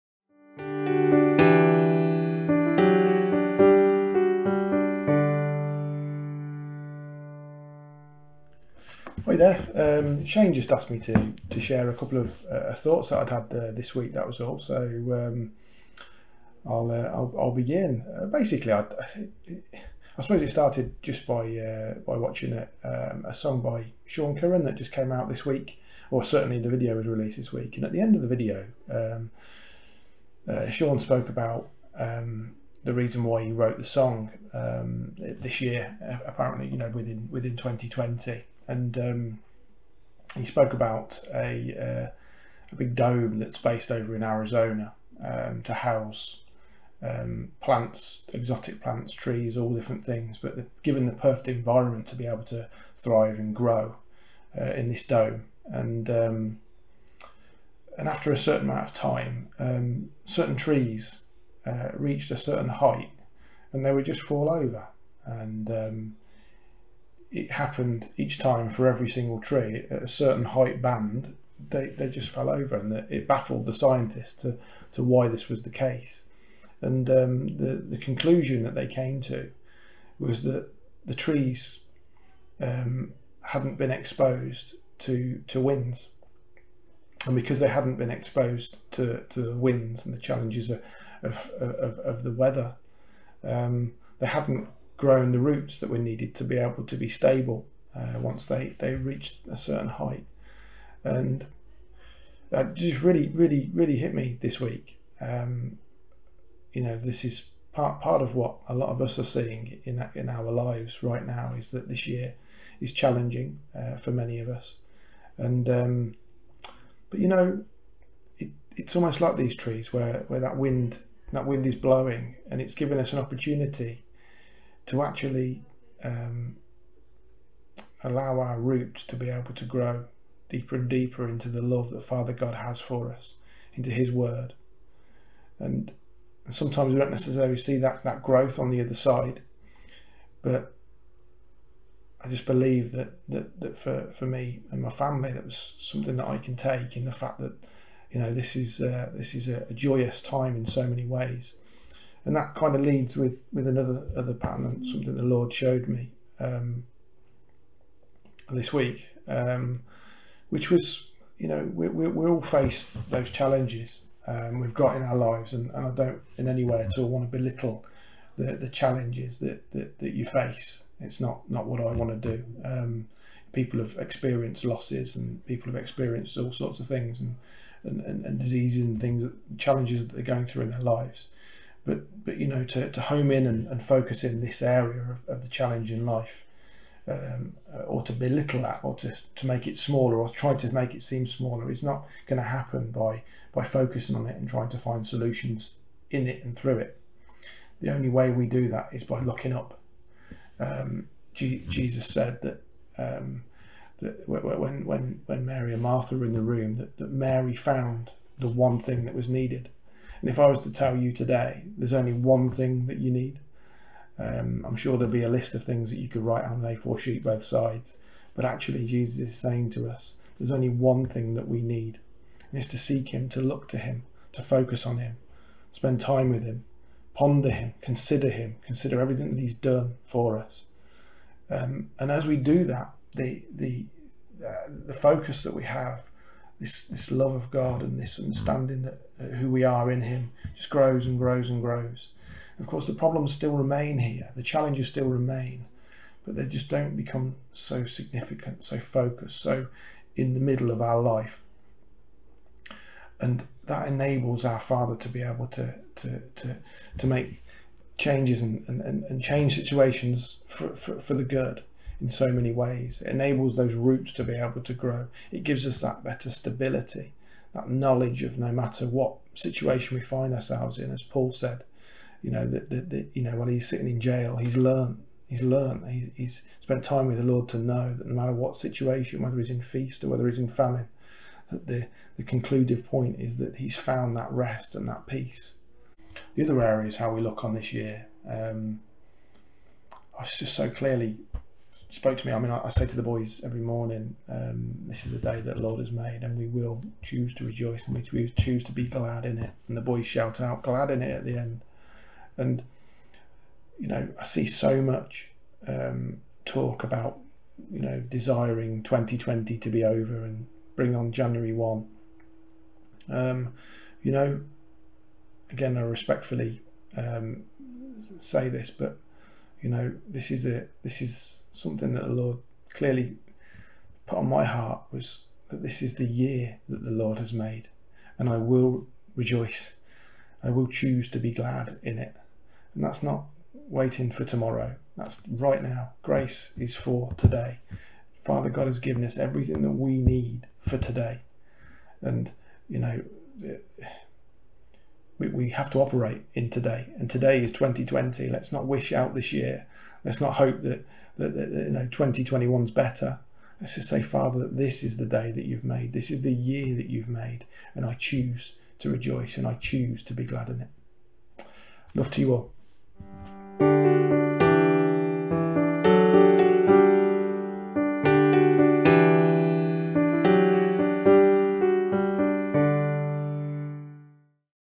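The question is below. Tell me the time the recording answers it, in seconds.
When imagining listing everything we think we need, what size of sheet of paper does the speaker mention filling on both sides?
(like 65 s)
216 s.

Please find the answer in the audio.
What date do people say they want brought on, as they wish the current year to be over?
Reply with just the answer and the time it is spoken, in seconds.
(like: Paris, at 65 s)
January 1, at 311 s.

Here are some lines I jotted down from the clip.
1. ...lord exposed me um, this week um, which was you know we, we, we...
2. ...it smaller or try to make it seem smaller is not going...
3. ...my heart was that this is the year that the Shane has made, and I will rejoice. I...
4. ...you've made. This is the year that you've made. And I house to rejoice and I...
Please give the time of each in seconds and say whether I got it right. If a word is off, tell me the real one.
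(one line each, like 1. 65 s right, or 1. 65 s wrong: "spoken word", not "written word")
1. 155 s wrong: "showed", not "exposed"
2. 189 s right
3. 324 s wrong: "Lord", not "Shane"
4. 355 s wrong: "choose", not "house".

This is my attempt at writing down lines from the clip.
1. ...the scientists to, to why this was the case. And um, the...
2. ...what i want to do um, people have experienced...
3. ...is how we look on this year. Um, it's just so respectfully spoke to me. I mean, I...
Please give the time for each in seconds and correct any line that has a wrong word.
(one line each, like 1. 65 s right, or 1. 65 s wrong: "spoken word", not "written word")
1. 73 s right
2. 171 s right
3. 286 s wrong: "clearly", not "respectfully".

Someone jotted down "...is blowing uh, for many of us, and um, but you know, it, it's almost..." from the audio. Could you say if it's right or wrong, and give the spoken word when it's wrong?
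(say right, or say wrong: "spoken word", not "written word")
wrong: "challenging", not "blowing".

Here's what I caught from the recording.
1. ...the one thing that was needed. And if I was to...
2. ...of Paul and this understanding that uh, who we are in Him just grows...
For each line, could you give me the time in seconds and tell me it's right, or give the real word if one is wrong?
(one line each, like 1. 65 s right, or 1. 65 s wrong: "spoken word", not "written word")
1. 208 s right
2. 237 s wrong: "God", not "Paul".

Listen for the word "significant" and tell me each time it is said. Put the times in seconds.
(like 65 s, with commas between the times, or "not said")
247 s.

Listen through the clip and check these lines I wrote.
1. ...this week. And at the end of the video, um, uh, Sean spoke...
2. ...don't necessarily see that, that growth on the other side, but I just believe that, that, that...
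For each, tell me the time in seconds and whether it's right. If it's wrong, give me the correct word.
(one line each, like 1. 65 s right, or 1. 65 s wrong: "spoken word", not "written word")
1. 27 s right
2. 136 s right.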